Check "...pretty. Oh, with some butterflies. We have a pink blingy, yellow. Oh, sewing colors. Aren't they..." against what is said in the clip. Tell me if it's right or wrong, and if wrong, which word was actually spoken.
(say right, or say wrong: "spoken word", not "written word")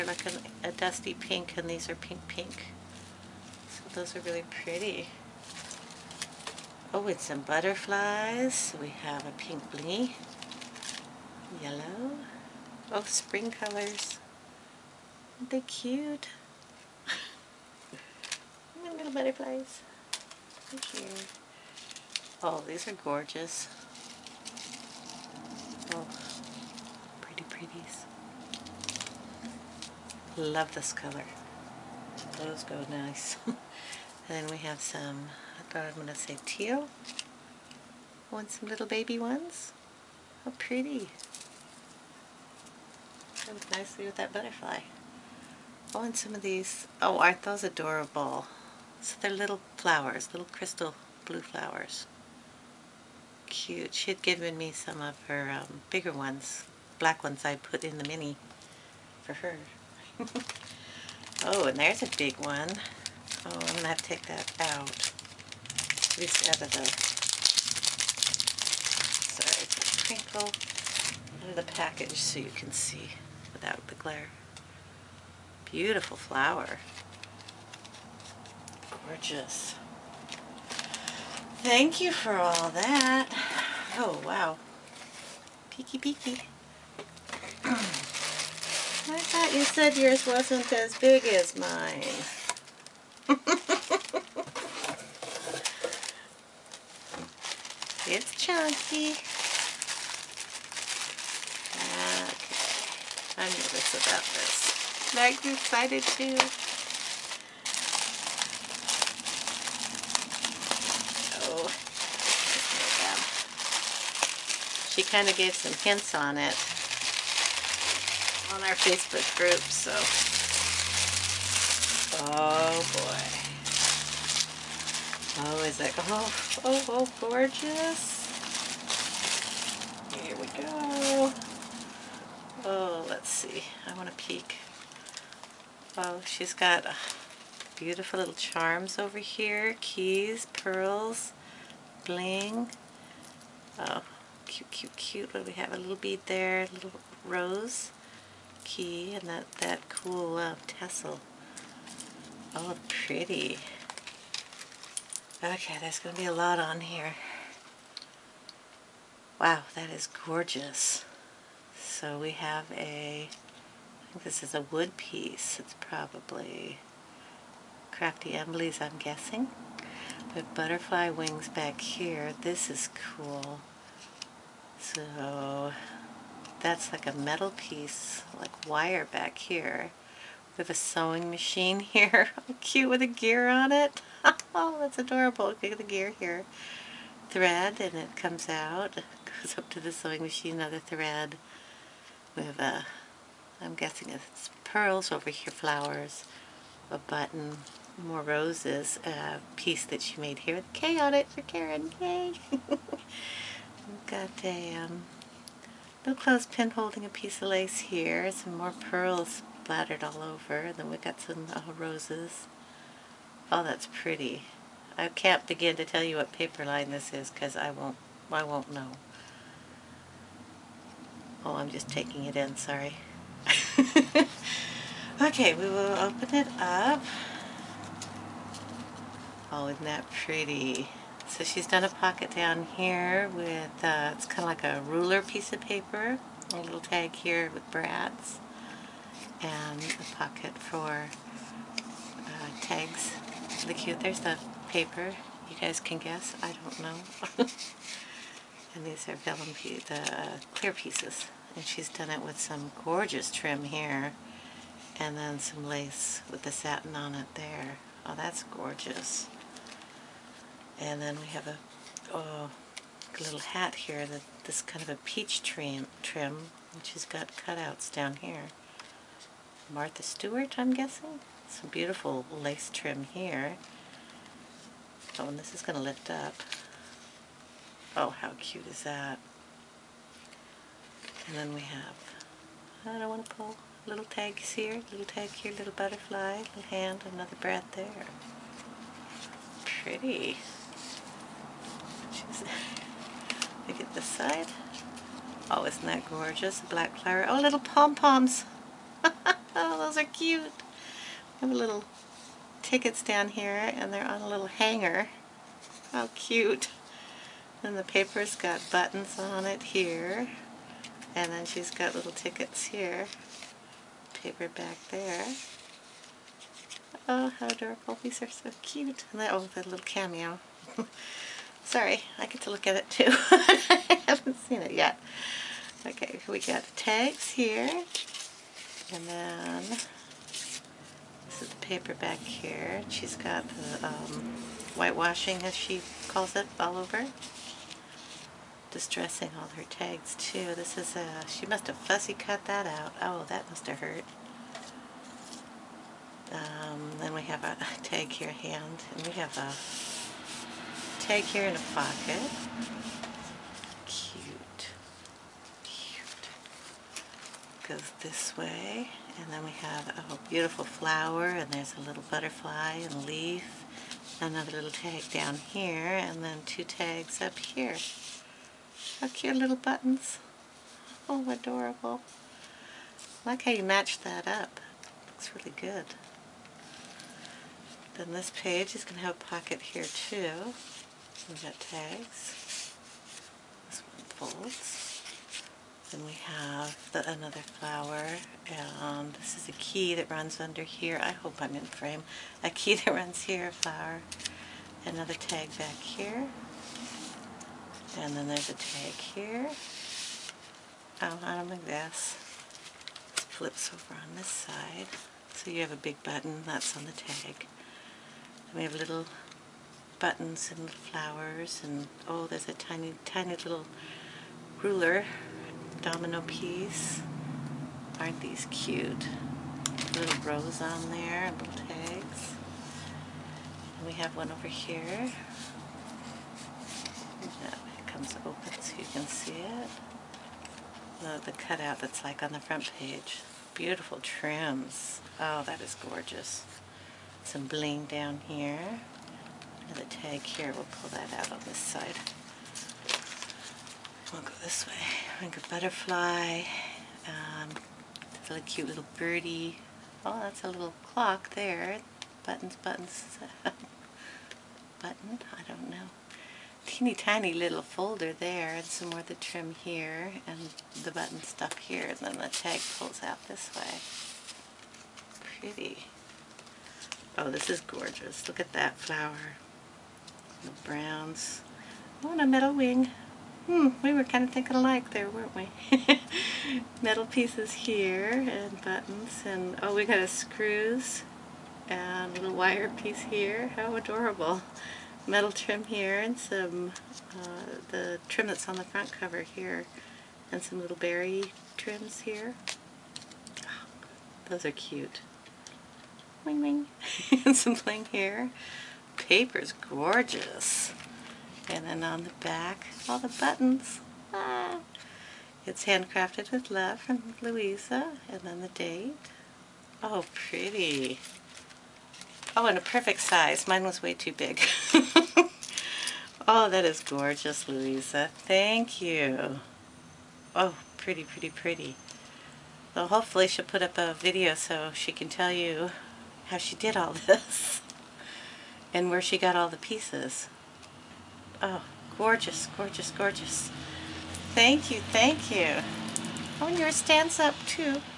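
wrong: "spring", not "sewing".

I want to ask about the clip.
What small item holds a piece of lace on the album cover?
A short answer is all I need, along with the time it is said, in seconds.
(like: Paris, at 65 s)
Clothespin, at 206 s.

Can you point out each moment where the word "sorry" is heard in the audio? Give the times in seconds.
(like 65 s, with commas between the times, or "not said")
69 s, 222 s, 321 s.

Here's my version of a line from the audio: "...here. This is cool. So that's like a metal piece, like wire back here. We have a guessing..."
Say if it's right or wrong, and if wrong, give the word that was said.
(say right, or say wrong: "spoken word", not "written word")
wrong: "sewing", not "guessing".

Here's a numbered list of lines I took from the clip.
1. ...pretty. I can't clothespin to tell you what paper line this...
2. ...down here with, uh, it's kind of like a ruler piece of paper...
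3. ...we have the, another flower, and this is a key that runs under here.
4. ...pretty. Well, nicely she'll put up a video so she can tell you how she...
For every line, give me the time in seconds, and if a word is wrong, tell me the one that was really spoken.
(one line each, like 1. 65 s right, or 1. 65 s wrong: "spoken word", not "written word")
1. 214 s wrong: "begin", not "clothespin"
2. 232 s right
3. 386 s right
4. 521 s wrong: "hopefully", not "nicely".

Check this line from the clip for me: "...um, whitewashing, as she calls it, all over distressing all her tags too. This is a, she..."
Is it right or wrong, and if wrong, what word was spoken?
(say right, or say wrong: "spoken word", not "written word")
right.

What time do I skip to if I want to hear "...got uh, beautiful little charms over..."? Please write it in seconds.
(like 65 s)
136 s.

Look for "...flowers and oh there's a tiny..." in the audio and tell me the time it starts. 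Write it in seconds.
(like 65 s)
410 s.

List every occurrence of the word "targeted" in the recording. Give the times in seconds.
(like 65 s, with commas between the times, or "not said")
not said.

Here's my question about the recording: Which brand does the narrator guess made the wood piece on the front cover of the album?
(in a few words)
Crafty Emblies.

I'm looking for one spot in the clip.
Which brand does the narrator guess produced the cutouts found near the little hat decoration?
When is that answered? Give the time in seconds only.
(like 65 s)
269 s.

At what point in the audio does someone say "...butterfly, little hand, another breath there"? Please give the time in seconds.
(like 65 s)
285 s.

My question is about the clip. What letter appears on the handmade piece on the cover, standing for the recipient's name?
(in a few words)
K.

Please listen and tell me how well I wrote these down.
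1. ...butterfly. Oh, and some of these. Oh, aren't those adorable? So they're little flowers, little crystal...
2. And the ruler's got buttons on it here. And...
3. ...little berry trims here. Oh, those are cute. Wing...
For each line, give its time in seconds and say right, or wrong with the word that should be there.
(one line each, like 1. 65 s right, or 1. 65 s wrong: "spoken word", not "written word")
1. 44 s right
2. 307 s wrong: "paper", not "ruler"
3. 490 s right.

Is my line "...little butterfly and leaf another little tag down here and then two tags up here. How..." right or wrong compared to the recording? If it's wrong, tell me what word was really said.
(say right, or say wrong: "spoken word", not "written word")
right.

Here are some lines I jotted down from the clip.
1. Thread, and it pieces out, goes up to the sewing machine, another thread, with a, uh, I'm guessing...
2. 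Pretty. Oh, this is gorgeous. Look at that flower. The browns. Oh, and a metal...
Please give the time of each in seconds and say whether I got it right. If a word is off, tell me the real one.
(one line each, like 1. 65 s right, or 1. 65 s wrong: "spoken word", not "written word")
1. 187 s wrong: "comes", not "pieces"
2. 465 s right.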